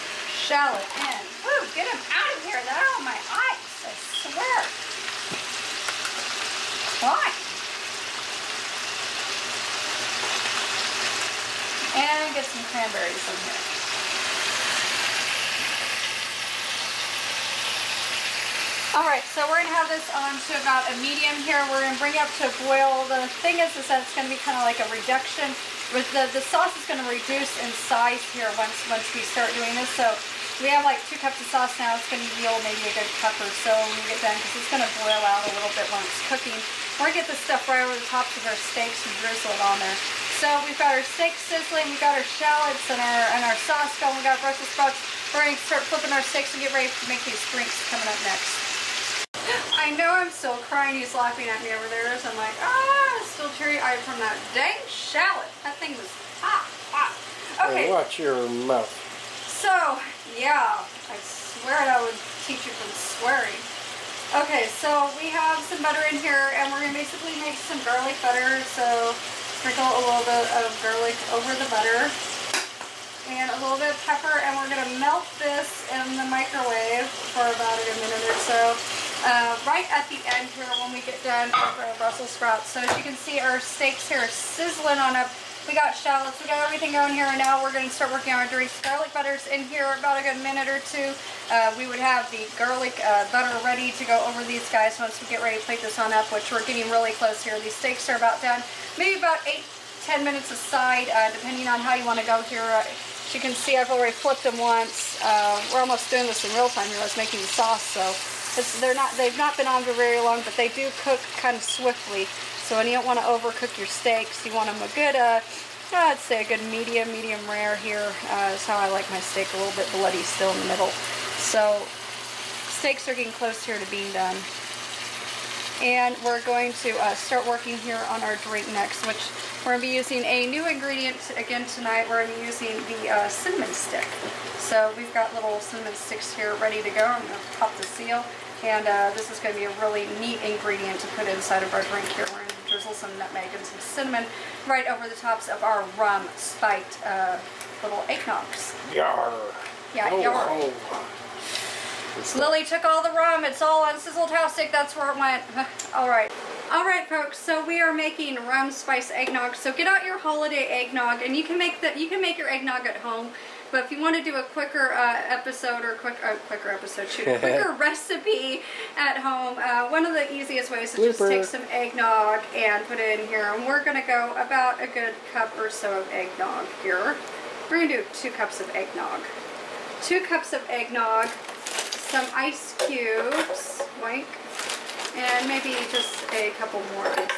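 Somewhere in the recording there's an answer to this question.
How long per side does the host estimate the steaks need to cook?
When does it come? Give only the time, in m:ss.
1:39.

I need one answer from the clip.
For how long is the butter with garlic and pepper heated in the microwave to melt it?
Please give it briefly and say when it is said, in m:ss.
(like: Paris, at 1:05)
about a minute, at 1:17.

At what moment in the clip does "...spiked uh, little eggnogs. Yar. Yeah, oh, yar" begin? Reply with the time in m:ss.
2:26.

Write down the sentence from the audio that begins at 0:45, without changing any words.
We're gonna start flipping our steaks and get ready to make these drinks coming up next.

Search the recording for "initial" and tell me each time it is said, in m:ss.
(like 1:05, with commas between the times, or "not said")
not said.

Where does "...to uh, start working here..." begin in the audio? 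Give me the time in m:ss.
2:06.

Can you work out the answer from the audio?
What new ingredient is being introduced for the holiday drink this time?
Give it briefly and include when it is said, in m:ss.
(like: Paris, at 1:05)
cinnamon stick, at 2:13.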